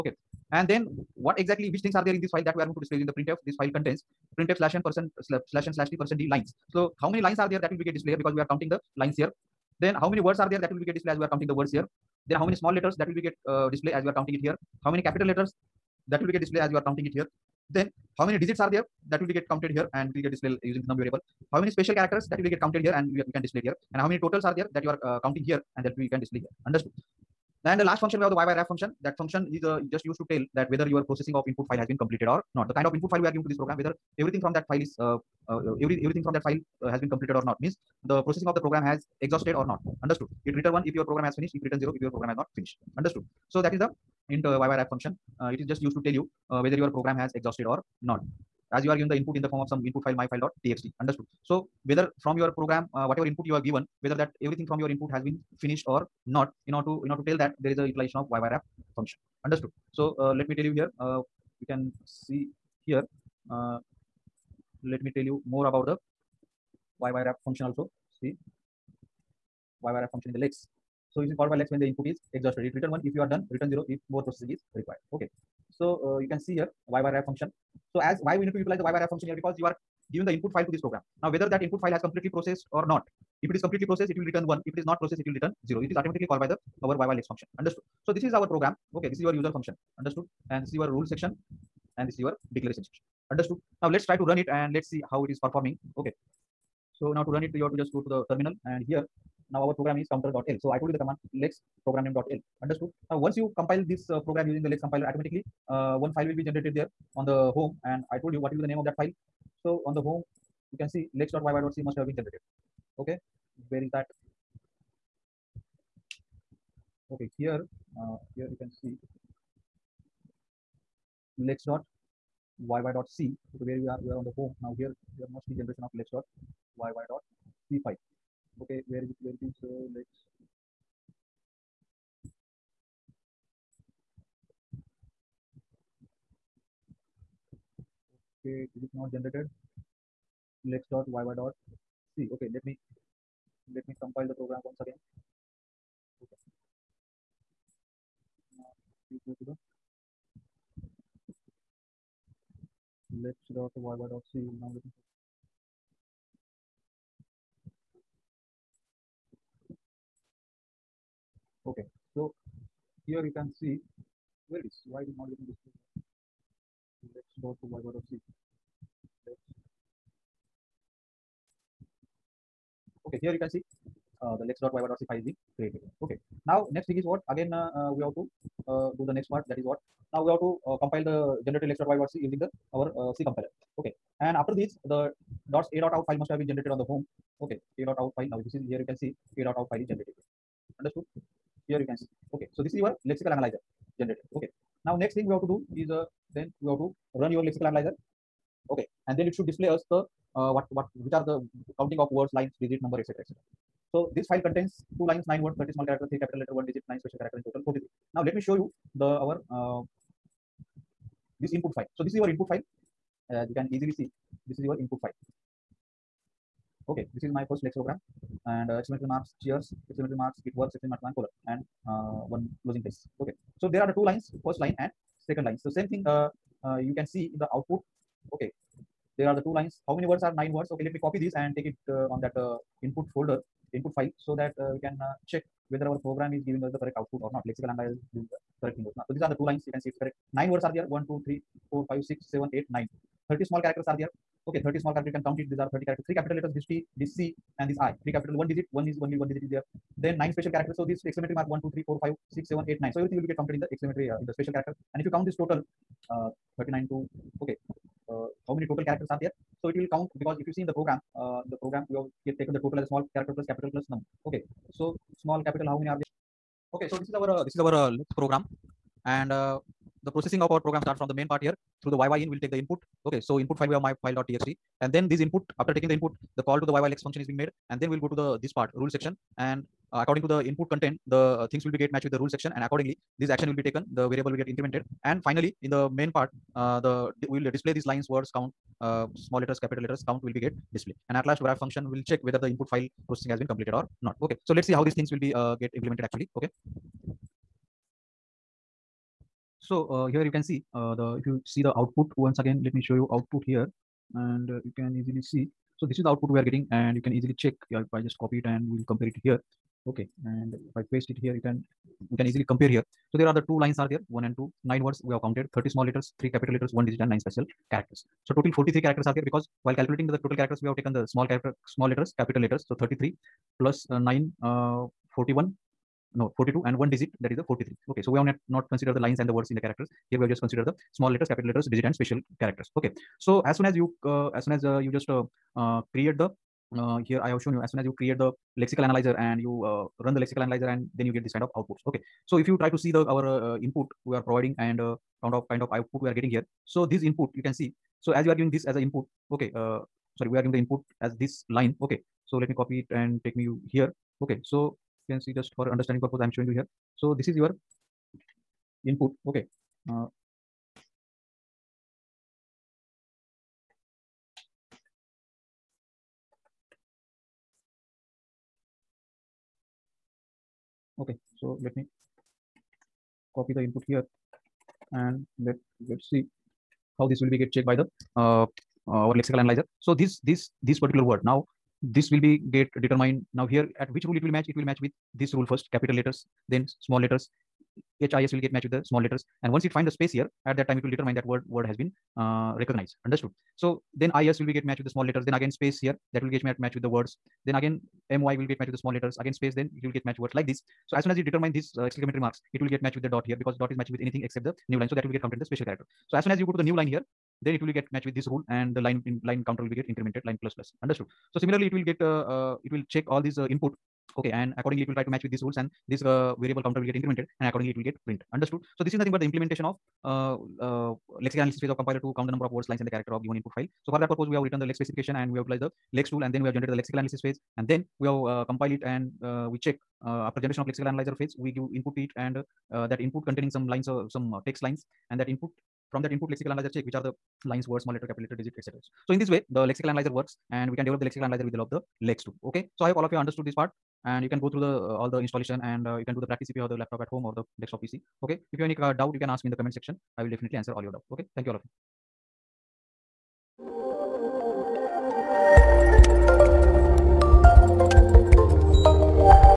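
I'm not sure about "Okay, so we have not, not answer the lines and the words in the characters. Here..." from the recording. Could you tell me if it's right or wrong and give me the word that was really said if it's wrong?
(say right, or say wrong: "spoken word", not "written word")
wrong: "consider", not "answer".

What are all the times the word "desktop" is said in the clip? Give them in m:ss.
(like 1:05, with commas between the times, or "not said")
7:27.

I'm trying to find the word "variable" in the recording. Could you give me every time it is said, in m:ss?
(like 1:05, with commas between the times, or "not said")
0:20, 4:44, 6:56.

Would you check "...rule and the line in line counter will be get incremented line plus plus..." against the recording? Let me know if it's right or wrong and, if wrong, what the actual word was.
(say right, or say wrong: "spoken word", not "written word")
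right.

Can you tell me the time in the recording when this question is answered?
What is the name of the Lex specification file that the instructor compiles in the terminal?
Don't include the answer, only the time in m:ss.
1:40.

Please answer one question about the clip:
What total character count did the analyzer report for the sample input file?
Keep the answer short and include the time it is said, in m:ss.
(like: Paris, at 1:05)
43, at 5:18.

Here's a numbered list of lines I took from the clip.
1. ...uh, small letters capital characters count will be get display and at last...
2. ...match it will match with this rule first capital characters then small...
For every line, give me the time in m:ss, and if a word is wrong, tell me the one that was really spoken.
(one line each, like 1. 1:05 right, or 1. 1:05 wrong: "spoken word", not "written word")
1. 4:48 wrong: "letters", not "characters"
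2. 6:24 wrong: "letters", not "characters".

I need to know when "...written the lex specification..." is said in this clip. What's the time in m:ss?
7:04.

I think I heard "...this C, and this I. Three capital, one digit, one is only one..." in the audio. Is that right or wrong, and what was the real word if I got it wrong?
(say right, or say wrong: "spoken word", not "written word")
right.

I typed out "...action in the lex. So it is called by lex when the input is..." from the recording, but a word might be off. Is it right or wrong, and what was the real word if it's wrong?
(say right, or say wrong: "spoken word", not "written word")
wrong: "function", not "action".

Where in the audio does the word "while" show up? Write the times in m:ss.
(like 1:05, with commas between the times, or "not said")
5:19.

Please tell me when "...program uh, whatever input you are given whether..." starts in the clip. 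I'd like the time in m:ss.
0:52.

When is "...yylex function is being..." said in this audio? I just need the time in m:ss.
4:36.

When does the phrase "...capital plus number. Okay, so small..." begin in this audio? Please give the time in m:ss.
4:23.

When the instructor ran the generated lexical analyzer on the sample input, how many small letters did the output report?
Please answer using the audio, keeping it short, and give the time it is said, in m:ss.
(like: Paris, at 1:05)
30, at 3:25.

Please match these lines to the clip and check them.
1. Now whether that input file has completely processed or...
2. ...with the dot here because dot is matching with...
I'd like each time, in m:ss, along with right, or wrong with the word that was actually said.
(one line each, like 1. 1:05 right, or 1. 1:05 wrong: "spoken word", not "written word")
1. 1:21 right
2. 6:42 right.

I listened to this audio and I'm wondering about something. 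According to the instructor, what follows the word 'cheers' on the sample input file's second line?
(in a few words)
it works.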